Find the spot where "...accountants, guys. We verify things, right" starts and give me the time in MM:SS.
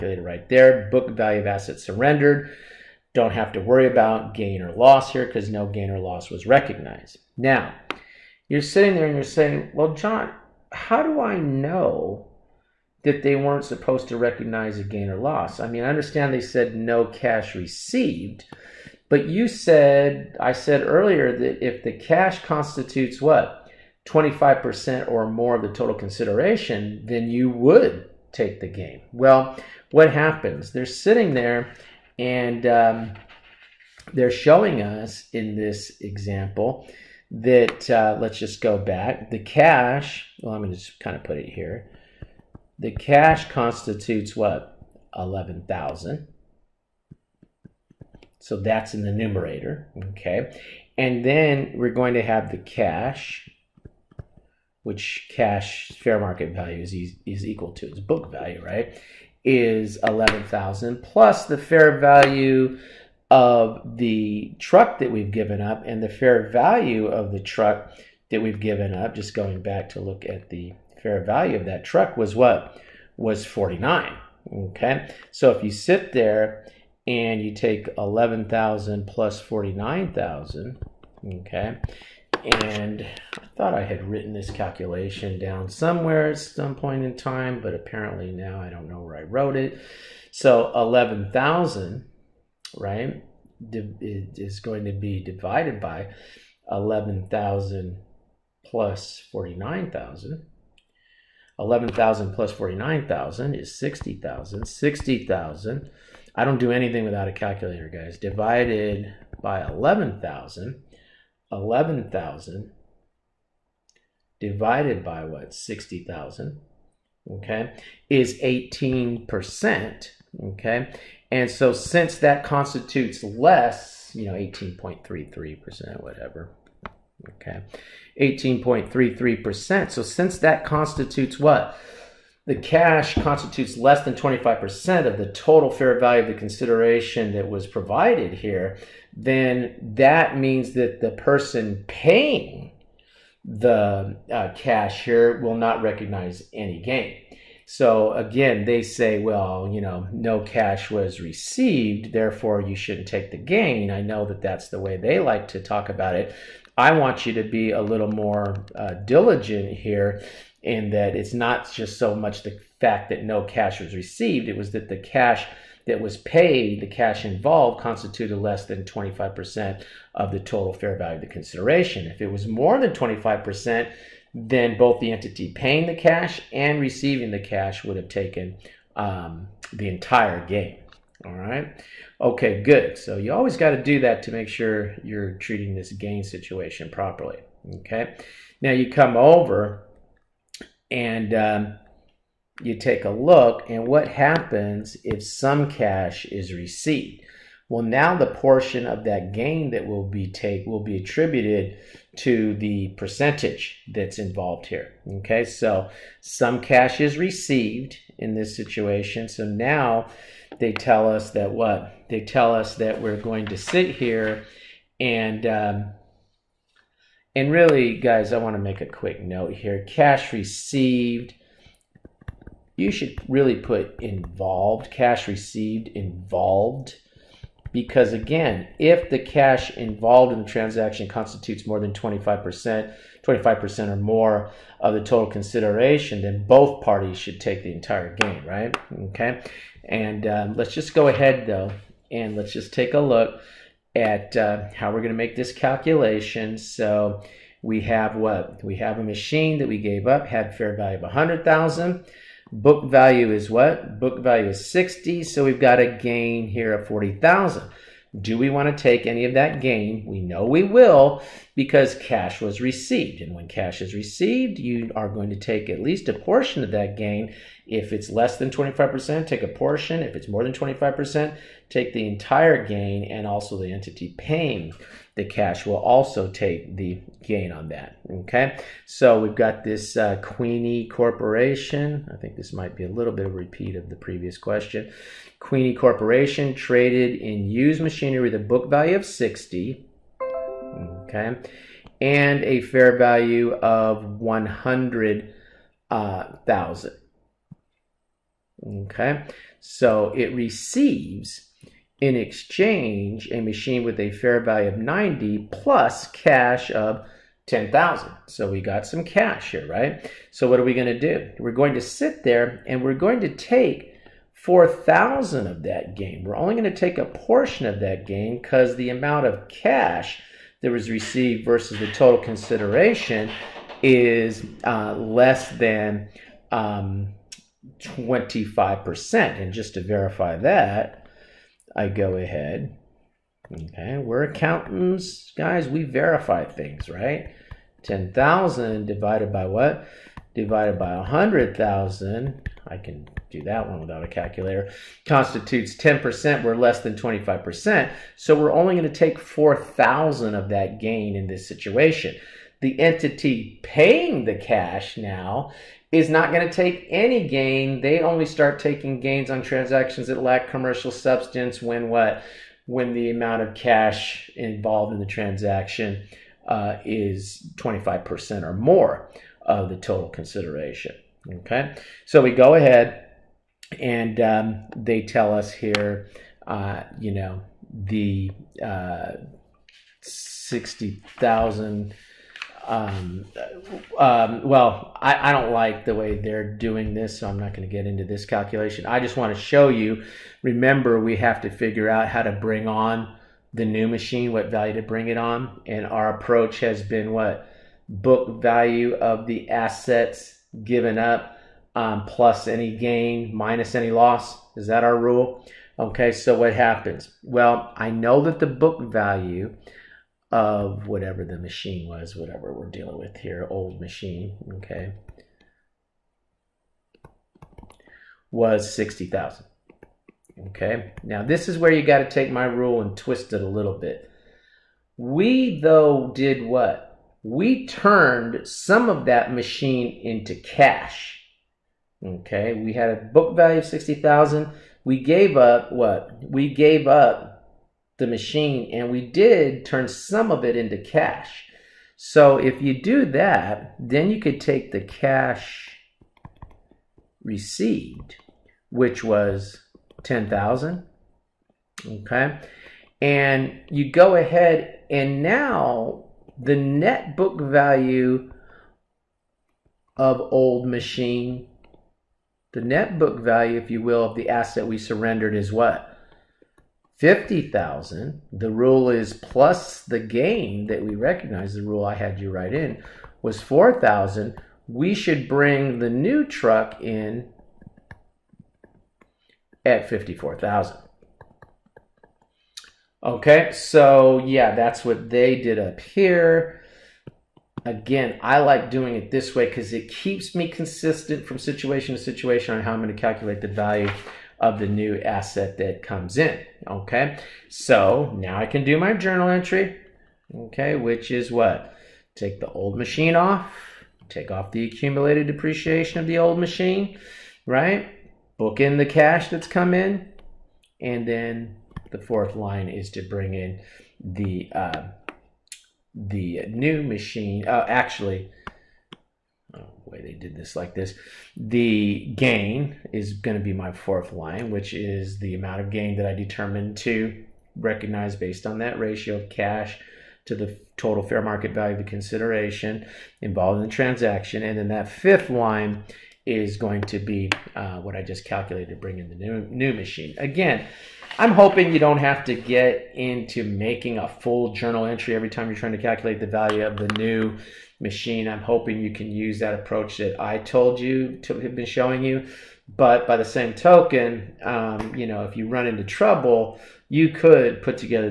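05:34.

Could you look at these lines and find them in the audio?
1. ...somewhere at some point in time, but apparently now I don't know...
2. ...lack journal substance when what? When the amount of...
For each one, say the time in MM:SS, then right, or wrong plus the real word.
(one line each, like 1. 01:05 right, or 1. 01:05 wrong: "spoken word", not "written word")
1. 01:25 right
2. 06:00 wrong: "commercial", not "journal".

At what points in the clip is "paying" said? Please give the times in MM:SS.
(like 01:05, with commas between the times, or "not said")
02:21, 02:55, 04:34, 05:53.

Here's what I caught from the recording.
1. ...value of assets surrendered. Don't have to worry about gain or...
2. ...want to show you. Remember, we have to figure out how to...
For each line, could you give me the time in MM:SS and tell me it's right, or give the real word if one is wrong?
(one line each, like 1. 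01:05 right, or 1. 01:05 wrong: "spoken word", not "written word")
1. 00:01 right
2. 06:29 right.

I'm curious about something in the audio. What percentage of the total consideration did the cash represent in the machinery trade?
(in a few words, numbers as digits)
10%.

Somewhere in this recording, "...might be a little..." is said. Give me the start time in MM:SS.
04:42.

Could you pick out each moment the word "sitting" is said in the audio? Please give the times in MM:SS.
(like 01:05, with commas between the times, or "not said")
00:08, 00:30.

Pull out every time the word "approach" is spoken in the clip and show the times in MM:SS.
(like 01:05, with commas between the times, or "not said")
06:36, 09:09.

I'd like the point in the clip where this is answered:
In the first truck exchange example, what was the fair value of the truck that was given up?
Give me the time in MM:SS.
01:13.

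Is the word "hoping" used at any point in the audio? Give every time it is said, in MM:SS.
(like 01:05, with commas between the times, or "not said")
09:01, 09:08.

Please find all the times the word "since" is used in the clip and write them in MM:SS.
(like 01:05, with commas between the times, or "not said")
02:01, 02:10.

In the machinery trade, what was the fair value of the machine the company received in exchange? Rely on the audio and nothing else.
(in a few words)
90,000.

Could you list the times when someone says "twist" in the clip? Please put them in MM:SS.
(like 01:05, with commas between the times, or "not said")
07:02.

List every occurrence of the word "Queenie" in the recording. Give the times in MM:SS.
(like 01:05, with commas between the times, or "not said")
04:40, 04:45.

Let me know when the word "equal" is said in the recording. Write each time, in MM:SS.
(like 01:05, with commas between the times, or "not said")
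00:57.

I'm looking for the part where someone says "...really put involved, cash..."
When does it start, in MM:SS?
03:43.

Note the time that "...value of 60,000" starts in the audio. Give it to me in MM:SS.
07:13.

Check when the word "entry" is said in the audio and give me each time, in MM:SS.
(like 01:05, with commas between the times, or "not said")
08:19, 09:04.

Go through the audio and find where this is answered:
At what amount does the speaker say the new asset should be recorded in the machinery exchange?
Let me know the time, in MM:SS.
07:59.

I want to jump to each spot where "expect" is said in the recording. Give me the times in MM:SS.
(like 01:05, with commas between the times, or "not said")
not said.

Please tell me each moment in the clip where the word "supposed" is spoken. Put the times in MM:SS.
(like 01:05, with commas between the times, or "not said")
00:13.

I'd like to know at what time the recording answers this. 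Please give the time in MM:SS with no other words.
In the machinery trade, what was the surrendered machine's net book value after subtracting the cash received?
07:46.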